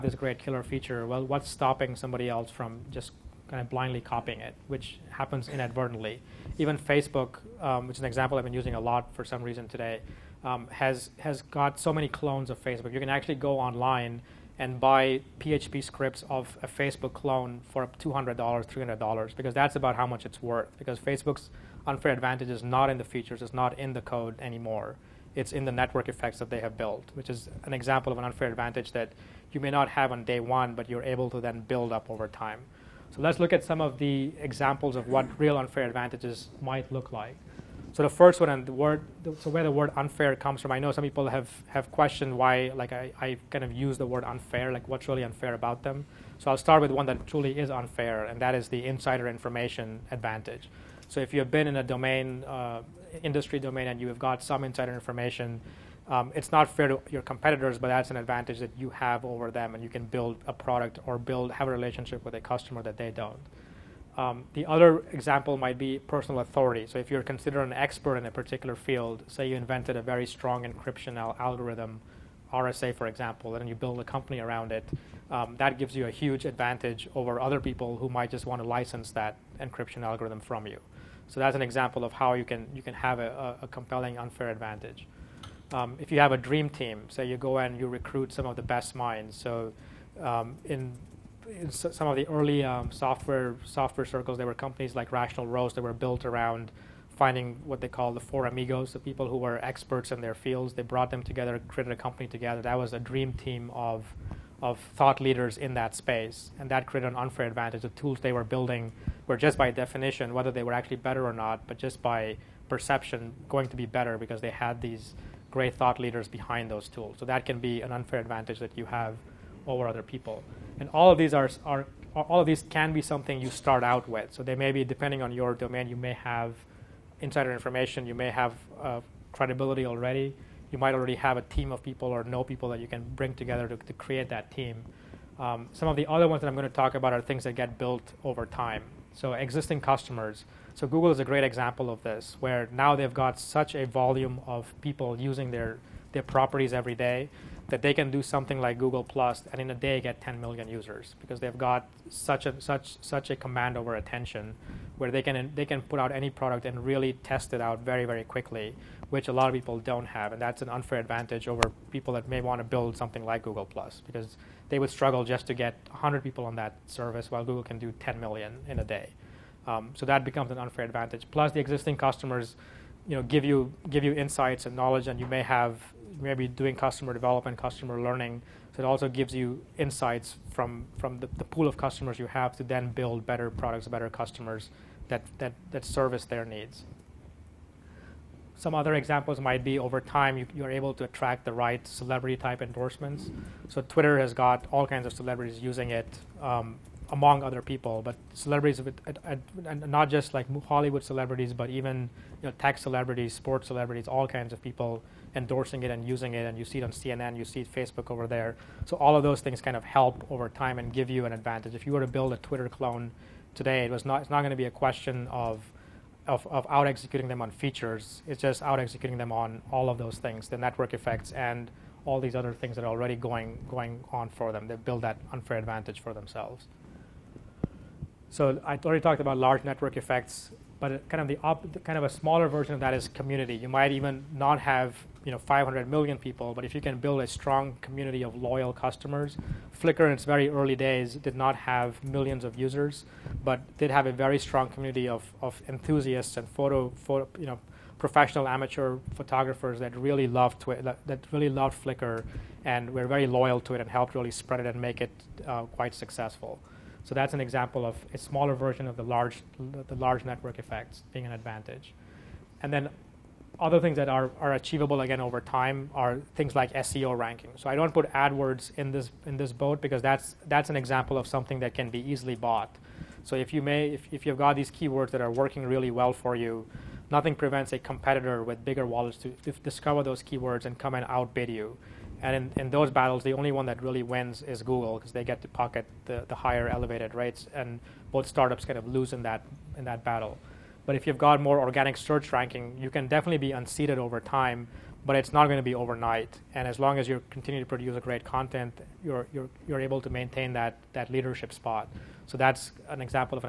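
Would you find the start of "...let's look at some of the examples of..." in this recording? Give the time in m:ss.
0:33.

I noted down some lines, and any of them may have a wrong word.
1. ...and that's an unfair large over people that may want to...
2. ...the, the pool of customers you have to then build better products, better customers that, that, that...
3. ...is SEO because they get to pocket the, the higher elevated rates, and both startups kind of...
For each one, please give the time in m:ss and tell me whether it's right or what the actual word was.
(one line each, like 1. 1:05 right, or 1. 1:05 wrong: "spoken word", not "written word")
1. 2:40 wrong: "advantage", not "large"
2. 3:01 right
3. 4:44 wrong: "Google", not "SEO".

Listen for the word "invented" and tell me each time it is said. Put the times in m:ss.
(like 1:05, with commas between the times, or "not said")
1:09.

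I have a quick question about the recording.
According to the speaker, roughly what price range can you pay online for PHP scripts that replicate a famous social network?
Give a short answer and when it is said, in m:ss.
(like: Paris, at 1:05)
$200, $300, at 0:17.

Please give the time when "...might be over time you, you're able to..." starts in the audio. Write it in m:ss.
3:09.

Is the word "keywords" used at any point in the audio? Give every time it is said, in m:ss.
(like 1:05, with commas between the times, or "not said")
4:34, 4:40.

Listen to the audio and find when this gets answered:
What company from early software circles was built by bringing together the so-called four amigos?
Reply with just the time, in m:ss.
1:35.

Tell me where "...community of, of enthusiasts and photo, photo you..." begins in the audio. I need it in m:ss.
4:04.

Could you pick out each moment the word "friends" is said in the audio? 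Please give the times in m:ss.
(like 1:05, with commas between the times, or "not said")
not said.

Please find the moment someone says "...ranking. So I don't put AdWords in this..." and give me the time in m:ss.
4:27.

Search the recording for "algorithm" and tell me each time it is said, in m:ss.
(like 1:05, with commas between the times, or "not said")
1:11, 1:20.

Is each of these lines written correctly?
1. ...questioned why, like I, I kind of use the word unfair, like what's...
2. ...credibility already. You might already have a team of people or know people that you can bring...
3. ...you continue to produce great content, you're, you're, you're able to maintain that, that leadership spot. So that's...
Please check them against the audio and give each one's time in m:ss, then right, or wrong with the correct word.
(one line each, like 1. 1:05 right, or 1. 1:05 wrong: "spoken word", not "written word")
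1. 0:41 right
2. 2:09 right
3. 4:57 right.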